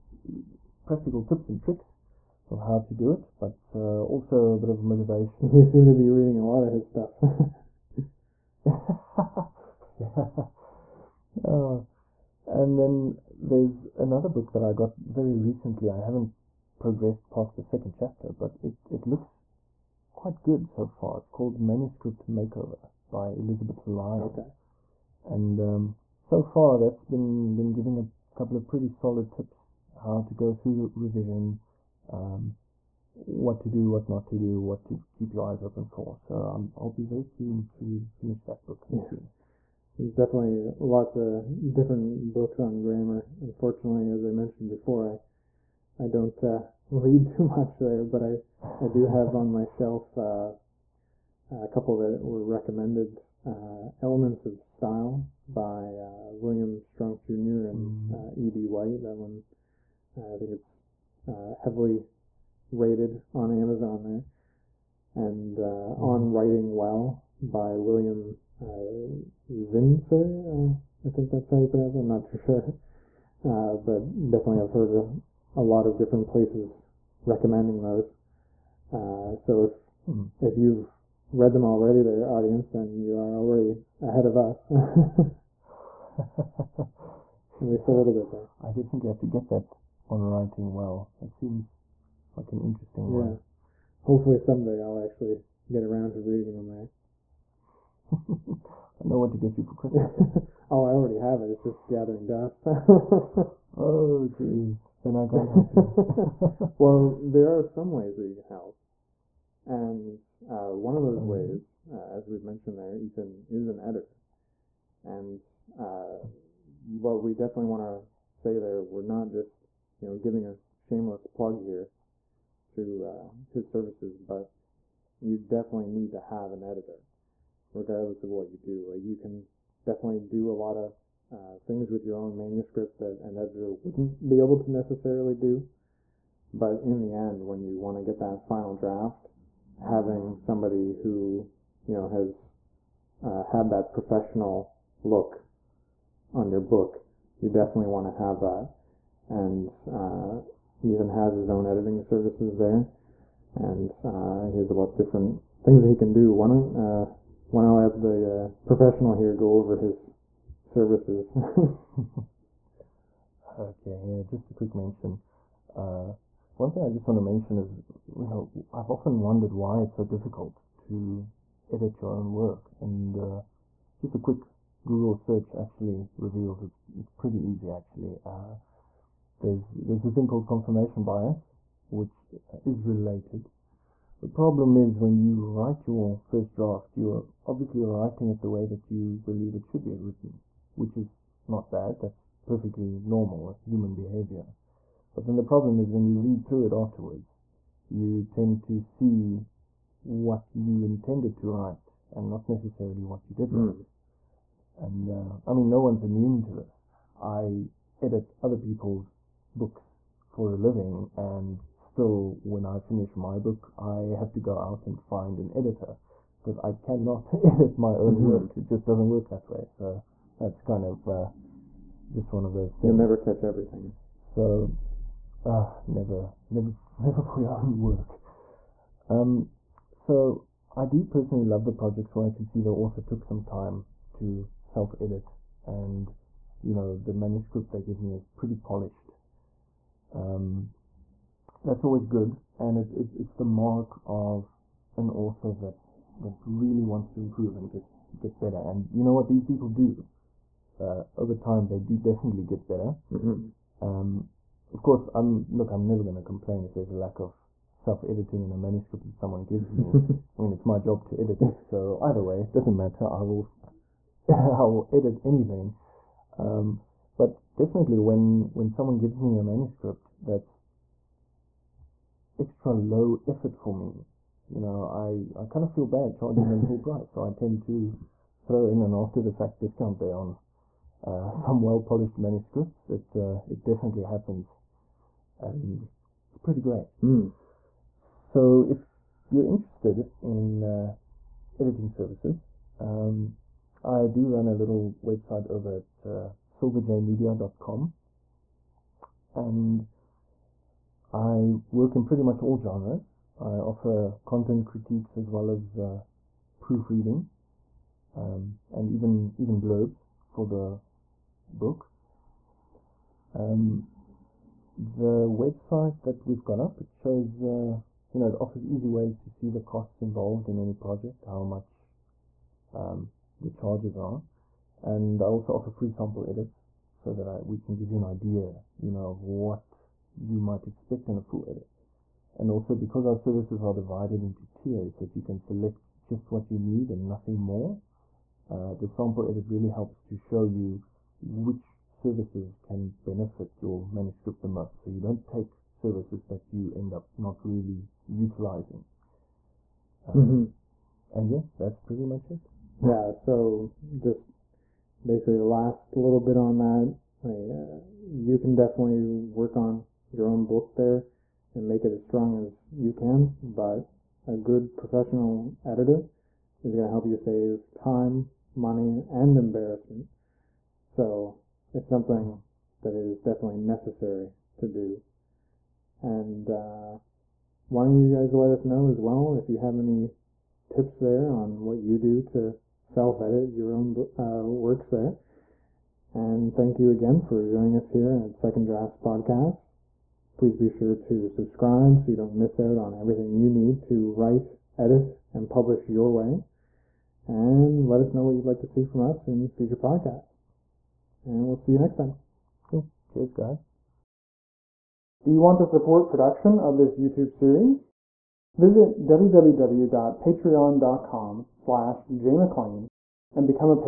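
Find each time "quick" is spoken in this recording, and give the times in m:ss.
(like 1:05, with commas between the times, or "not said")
2:44, 2:54.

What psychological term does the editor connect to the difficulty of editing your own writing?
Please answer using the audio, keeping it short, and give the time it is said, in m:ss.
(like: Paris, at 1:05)
confirmation bias, at 3:00.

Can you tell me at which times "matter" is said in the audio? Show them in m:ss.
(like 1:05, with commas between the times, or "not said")
4:22.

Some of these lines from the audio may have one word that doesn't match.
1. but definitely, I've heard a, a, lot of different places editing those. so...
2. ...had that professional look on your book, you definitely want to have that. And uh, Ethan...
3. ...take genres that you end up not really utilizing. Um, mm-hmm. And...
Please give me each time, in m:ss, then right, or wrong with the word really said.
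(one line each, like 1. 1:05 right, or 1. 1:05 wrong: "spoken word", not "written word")
1. 1:13 wrong: "recommending", not "editing"
2. 2:23 right
3. 5:45 wrong: "services", not "genres".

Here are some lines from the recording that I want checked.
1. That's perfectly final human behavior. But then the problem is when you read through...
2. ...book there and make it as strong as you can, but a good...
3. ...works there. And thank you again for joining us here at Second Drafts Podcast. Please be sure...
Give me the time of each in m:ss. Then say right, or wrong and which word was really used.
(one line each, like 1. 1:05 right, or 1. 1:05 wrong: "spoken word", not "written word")
1. 3:12 wrong: "normal", not "final"
2. 6:00 right
3. 6:24 right.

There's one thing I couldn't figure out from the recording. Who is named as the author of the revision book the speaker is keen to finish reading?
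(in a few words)
Elizabeth Lyon.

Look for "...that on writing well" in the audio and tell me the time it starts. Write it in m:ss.
1:29.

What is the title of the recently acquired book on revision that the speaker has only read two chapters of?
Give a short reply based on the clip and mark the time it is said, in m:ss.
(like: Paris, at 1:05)
Manuscript Makeover, at 0:21.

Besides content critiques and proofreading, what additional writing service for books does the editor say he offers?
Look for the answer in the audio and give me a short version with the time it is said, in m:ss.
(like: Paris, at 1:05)
blurbs, at 5:09.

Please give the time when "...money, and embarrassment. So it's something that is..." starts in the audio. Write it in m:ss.
6:08.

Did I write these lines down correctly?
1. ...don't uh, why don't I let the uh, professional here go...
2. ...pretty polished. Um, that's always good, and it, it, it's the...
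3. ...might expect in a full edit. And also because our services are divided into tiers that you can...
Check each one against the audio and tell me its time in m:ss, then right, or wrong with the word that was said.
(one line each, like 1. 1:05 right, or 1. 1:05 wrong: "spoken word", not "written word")
1. 2:36 right
2. 3:58 right
3. 5:30 right.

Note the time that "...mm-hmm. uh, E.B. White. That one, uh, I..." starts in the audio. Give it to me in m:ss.
0:57.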